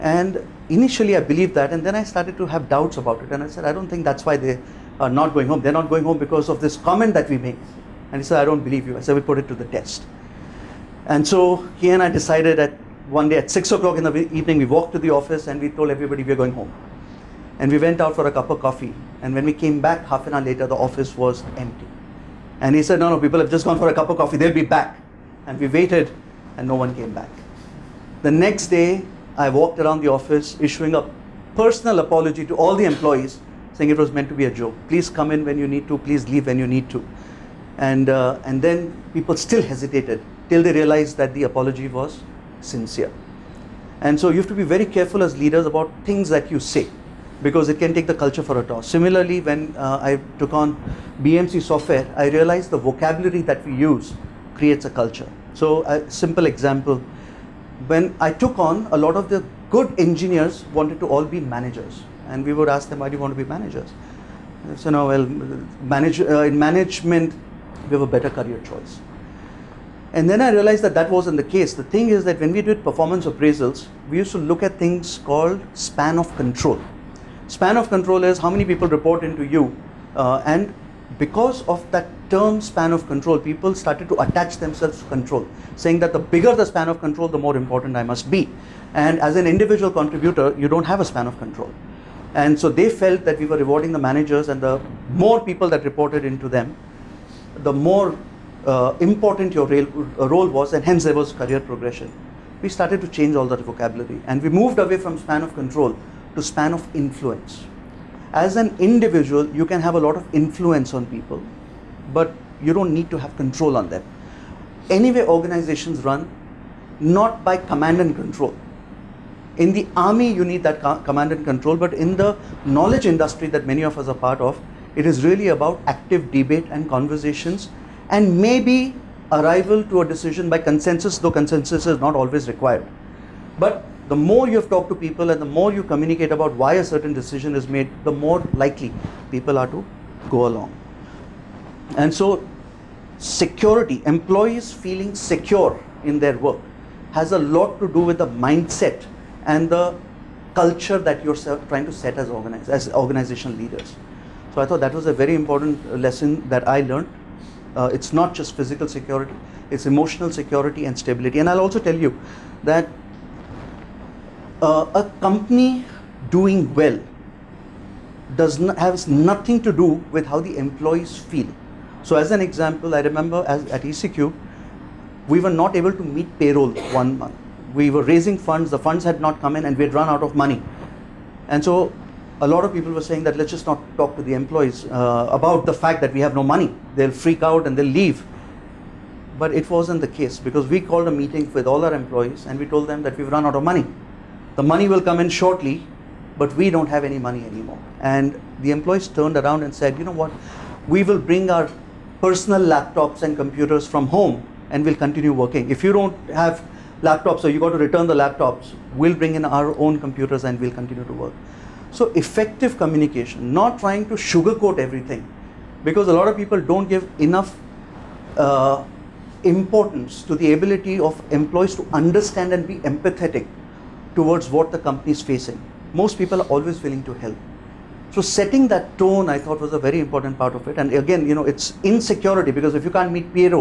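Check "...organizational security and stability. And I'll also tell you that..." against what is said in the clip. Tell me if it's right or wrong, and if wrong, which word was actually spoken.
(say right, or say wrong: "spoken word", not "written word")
wrong: "emotional", not "organizational".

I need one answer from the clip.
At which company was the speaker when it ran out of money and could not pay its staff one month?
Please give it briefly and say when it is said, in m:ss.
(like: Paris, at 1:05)
ECQ, at 2:53.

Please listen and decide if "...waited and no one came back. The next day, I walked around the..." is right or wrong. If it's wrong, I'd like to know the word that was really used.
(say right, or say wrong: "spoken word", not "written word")
right.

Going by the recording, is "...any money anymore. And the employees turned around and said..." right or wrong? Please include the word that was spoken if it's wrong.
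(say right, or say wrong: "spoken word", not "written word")
right.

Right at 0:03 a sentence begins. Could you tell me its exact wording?
And I said, I don't think that's why they are not going home.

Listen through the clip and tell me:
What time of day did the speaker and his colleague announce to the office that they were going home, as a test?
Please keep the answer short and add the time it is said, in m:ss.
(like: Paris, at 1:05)
6 o'clock in the evening, at 0:13.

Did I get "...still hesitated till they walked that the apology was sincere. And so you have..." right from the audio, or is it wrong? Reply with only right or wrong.
wrong.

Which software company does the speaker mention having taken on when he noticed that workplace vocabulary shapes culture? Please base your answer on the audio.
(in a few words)
BMC Software.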